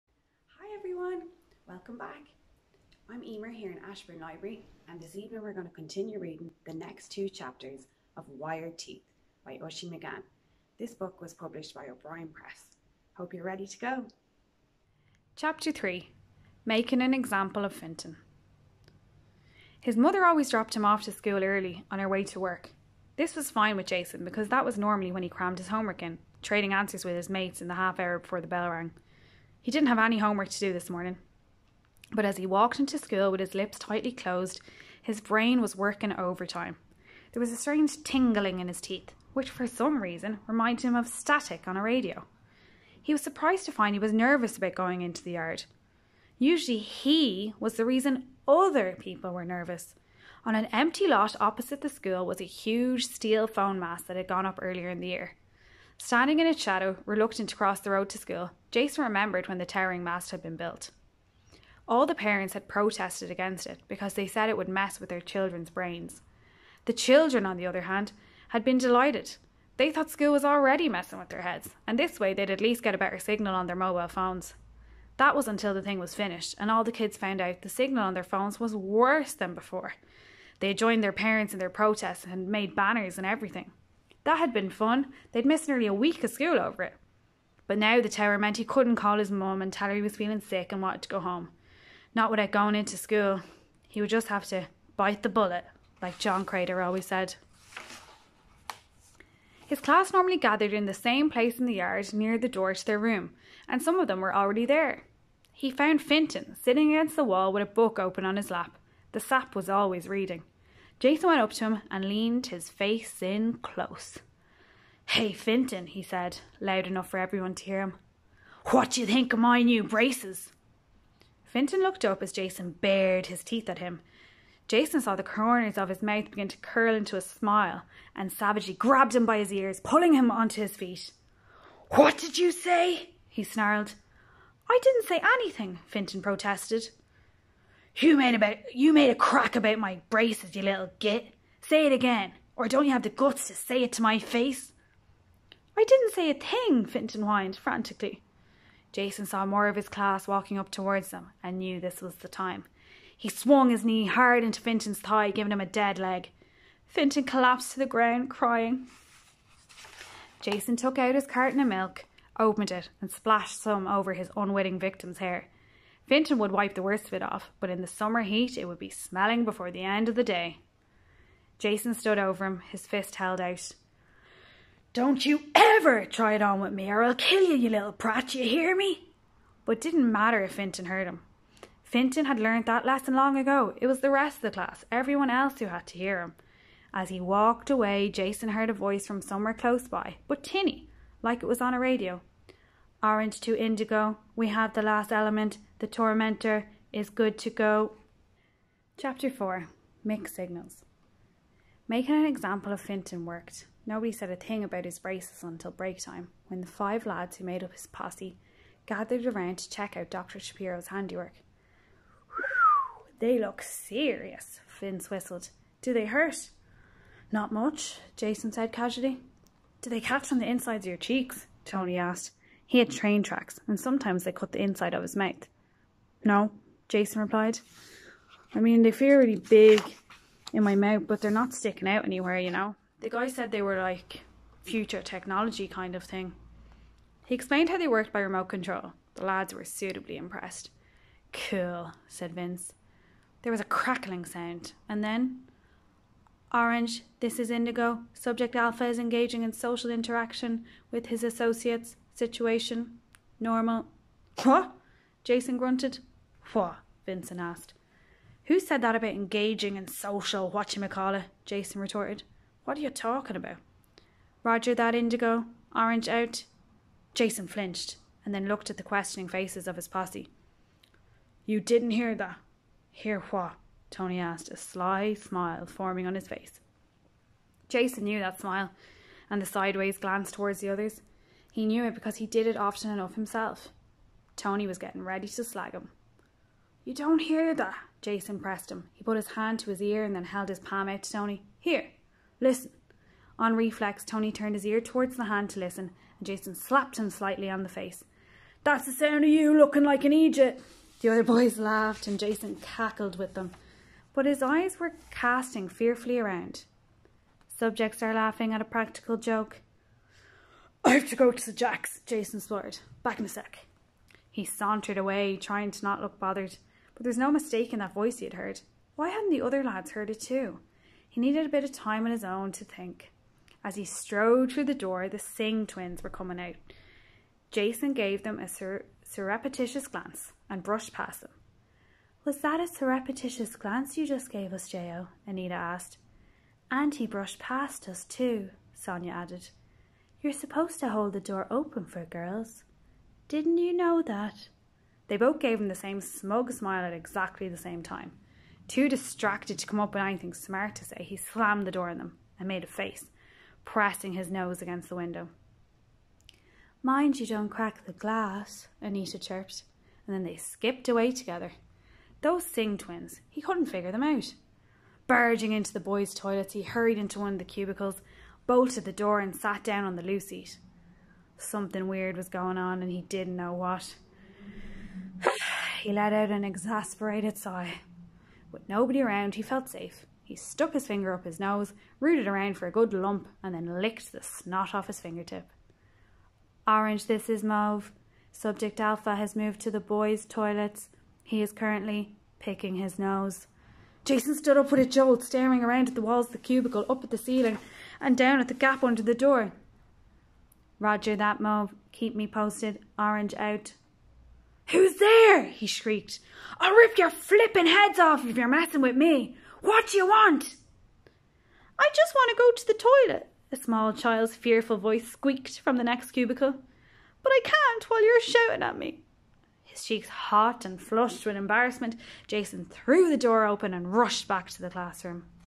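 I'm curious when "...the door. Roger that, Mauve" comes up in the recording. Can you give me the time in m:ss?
6:39.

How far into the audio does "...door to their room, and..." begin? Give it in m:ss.
1:42.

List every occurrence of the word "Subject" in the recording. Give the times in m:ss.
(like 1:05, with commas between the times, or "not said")
4:08, 5:07, 6:28.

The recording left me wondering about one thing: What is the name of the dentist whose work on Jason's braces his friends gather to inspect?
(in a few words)
Dr. Shapiro.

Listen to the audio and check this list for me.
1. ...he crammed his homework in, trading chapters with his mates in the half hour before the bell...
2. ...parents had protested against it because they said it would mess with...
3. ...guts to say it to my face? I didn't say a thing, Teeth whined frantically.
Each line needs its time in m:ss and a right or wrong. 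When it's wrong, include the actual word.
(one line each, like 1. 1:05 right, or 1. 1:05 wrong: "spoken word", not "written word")
1. 0:25 wrong: "answers", not "chapters"
2. 1:02 right
3. 2:23 wrong: "Finton", not "Teeth".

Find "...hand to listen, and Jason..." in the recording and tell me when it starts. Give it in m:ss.
4:55.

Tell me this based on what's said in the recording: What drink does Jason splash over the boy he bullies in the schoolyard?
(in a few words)
milk.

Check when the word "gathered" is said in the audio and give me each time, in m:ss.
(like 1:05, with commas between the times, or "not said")
1:40, 3:28.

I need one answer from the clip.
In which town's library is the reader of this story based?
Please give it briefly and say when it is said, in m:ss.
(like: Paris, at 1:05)
Ashbourne, at 0:03.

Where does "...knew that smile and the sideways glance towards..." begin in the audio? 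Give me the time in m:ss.
4:38.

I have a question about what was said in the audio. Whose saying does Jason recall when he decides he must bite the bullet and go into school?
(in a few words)
John Crater.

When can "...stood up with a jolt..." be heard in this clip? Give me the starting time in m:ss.
6:34.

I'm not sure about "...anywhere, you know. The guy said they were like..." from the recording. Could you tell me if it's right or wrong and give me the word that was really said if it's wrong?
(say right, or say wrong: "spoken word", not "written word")
right.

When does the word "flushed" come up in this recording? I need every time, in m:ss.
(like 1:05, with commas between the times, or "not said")
7:00.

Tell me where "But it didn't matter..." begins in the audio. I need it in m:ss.
2:59.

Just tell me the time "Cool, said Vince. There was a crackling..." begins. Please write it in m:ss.
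4:01.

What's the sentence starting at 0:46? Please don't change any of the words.
Usually he was the reason other people were nervous.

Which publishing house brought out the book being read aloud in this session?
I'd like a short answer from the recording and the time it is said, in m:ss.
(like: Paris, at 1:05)
O'Brien Press, at 0:11.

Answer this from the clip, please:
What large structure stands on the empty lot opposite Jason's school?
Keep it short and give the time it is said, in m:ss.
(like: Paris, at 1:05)
phone mast, at 0:53.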